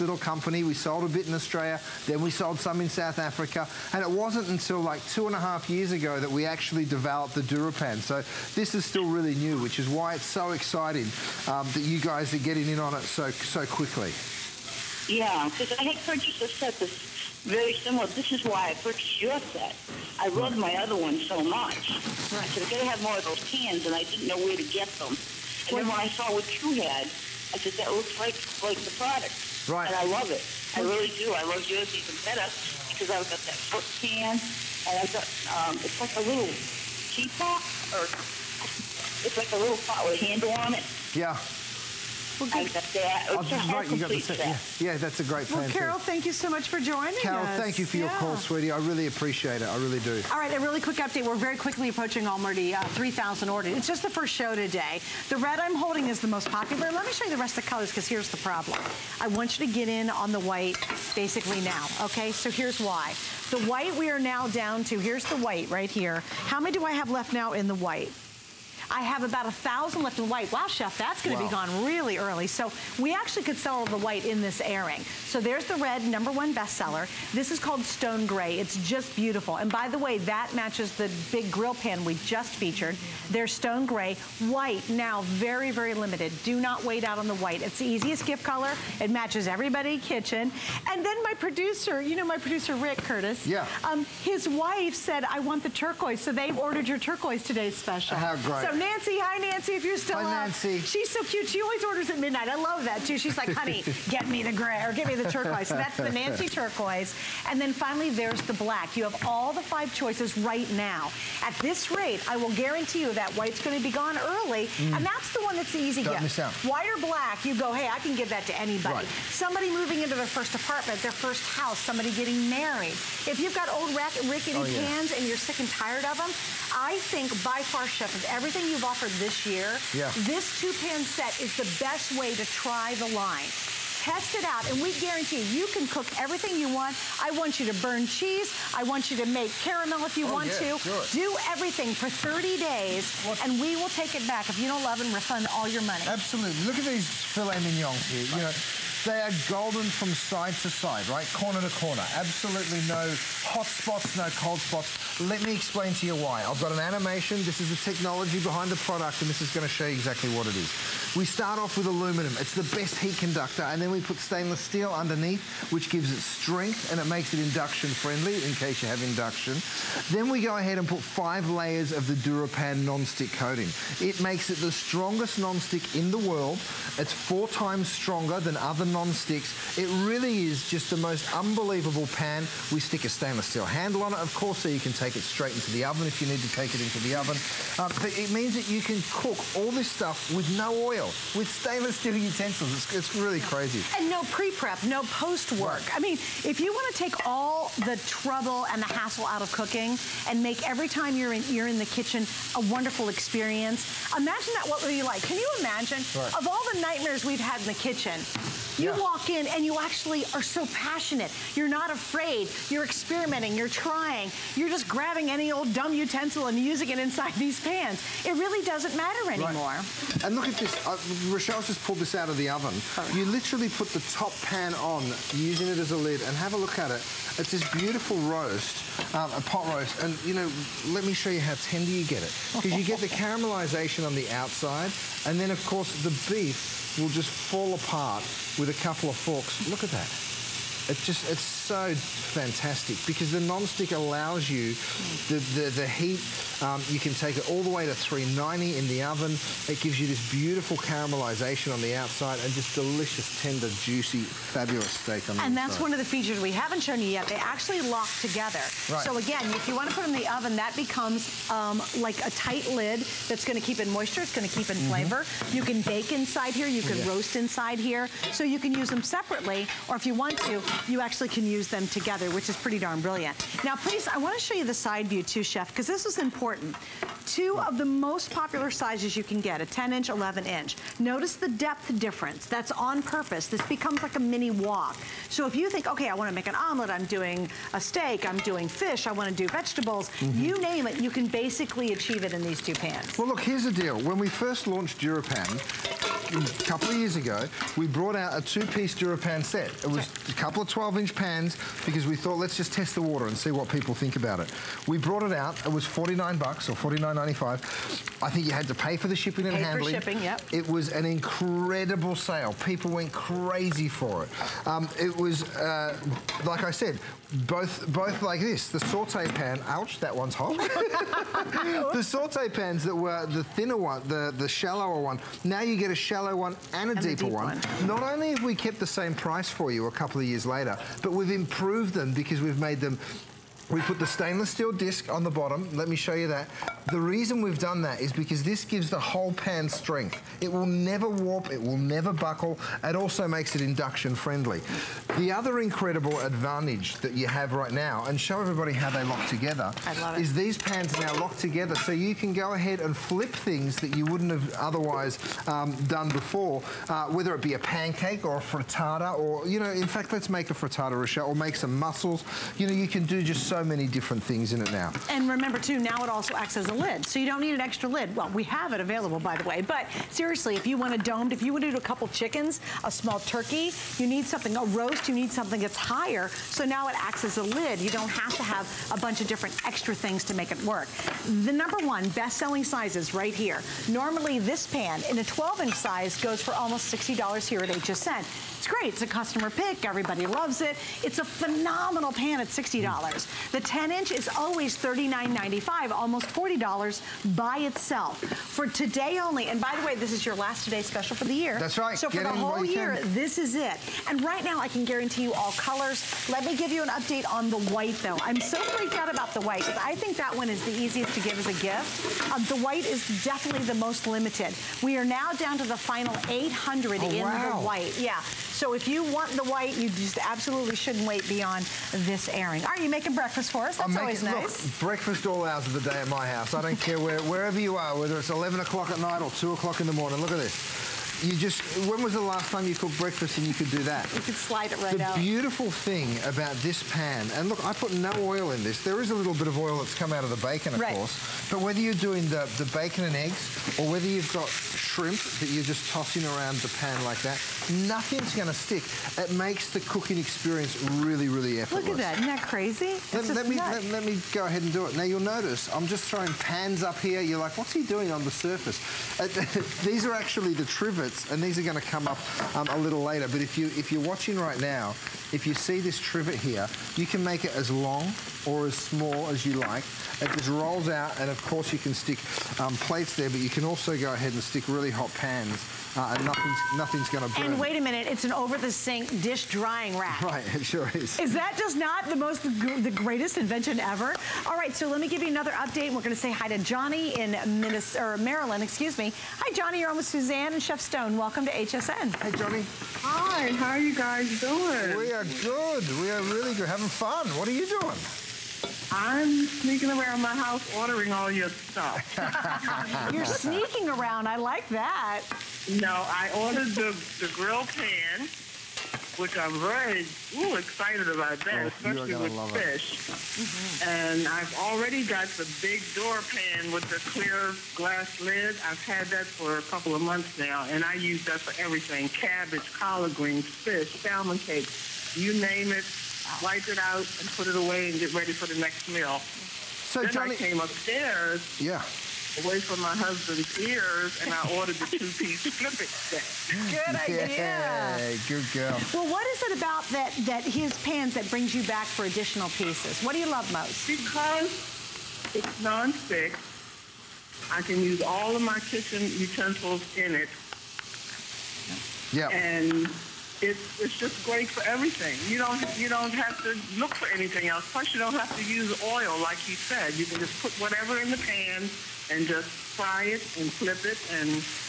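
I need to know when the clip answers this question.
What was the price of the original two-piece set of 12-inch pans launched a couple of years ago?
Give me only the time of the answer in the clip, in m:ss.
5:06.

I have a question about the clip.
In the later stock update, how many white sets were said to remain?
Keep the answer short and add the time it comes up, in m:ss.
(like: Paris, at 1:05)
800, at 6:56.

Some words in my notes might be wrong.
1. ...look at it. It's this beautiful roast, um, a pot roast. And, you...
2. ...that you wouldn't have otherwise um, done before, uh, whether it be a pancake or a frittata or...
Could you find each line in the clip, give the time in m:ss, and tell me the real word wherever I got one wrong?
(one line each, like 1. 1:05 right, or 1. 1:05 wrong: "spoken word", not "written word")
1. 3:46 right
2. 5:53 right.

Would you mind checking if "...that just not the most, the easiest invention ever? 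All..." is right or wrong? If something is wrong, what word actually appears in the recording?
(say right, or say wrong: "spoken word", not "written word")
wrong: "greatest", not "easiest".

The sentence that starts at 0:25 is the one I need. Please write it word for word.
And well, then when I saw what you had, I said, that looks like, like the product.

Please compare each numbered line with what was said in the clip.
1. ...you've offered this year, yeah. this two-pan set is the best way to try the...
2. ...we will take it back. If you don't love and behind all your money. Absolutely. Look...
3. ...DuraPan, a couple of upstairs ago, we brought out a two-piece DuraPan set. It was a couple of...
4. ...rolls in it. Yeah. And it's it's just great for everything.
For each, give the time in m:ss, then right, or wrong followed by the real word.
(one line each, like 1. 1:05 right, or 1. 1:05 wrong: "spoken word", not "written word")
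1. 2:08 right
2. 2:23 wrong: "refund", not "behind"
3. 4:55 wrong: "years", not "upstairs"
4. 9:09 wrong: "utensils", not "rolls".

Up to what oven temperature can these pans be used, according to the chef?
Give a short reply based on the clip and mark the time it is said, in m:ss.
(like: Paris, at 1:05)
390, at 4:07.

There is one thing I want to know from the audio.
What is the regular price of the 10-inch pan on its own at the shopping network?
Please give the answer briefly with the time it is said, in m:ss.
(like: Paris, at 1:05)
$39.95, at 6:34.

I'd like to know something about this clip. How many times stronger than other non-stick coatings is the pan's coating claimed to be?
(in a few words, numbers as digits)
four times.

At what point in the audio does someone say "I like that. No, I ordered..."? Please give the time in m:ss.
8:24.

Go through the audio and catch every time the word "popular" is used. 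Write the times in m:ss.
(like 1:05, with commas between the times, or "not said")
0:56, 4:38.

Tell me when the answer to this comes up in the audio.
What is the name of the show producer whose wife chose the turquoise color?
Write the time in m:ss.
1:32.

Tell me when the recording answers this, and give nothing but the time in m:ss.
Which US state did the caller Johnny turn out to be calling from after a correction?
8:08.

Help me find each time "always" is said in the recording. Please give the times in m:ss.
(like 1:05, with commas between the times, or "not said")
1:41, 6:34, 7:03.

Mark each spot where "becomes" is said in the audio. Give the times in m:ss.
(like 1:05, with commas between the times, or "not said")
4:20, 4:43.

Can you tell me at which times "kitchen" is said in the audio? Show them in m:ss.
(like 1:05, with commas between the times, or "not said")
1:29, 3:21, 3:27, 9:08.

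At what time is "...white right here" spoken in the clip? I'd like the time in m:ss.
1:05.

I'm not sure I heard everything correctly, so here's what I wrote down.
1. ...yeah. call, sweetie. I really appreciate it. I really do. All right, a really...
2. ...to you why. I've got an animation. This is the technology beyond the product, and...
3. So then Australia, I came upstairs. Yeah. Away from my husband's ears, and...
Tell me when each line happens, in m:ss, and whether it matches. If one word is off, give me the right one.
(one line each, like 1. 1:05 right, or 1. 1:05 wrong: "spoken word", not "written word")
1. 0:48 right
2. 2:35 wrong: "behind", not "beyond"
3. 8:49 wrong: "Johnny", not "Australia".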